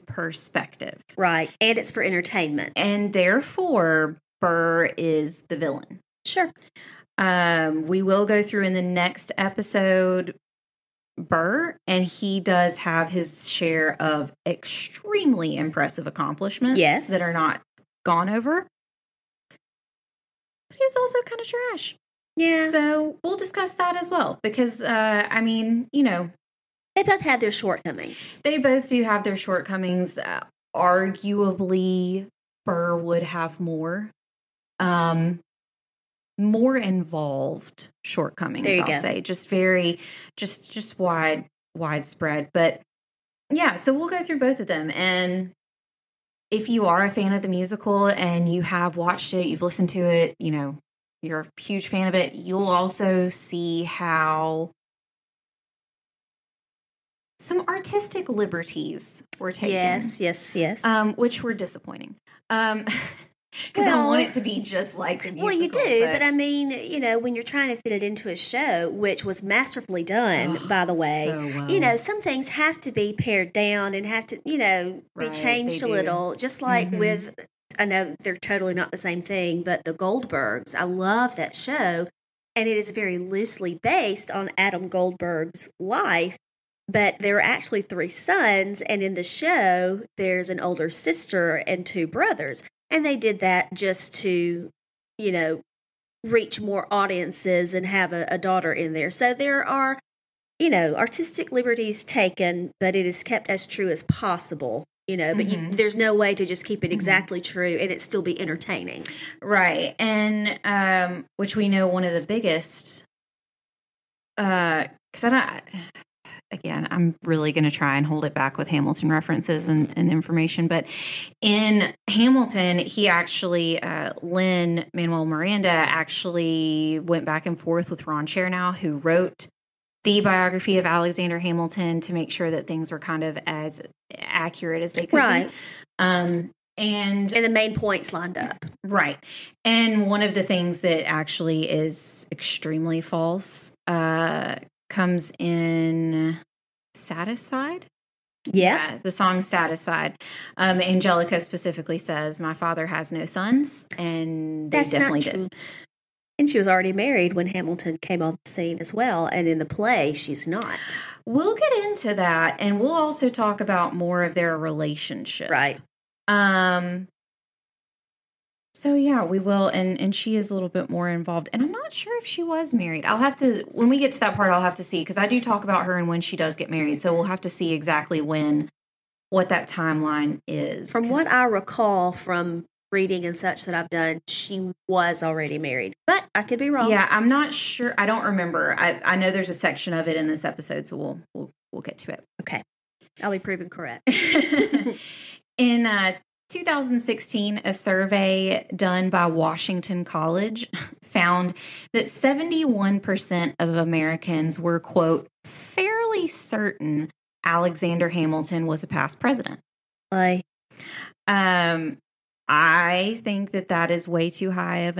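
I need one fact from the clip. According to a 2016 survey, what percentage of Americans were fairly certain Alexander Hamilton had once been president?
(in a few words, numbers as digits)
71%.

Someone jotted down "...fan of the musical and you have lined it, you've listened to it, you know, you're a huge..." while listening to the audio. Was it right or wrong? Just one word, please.
wrong.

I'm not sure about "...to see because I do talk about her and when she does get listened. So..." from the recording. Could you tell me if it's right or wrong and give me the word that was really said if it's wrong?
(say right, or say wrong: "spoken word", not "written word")
wrong: "married", not "listened".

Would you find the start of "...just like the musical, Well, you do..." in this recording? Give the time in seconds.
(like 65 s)
64 s.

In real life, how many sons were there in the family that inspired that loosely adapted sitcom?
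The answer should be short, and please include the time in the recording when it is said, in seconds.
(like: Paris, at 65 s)
3, at 87 s.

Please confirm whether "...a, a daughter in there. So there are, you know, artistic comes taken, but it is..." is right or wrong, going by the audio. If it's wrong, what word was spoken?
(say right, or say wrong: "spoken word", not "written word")
wrong: "liberties", not "comes".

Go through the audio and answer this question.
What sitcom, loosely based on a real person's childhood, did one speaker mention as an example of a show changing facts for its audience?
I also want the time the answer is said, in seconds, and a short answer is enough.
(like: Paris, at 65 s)
The Goldbergs, at 79 s.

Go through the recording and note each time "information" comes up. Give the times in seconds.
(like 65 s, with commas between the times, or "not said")
120 s.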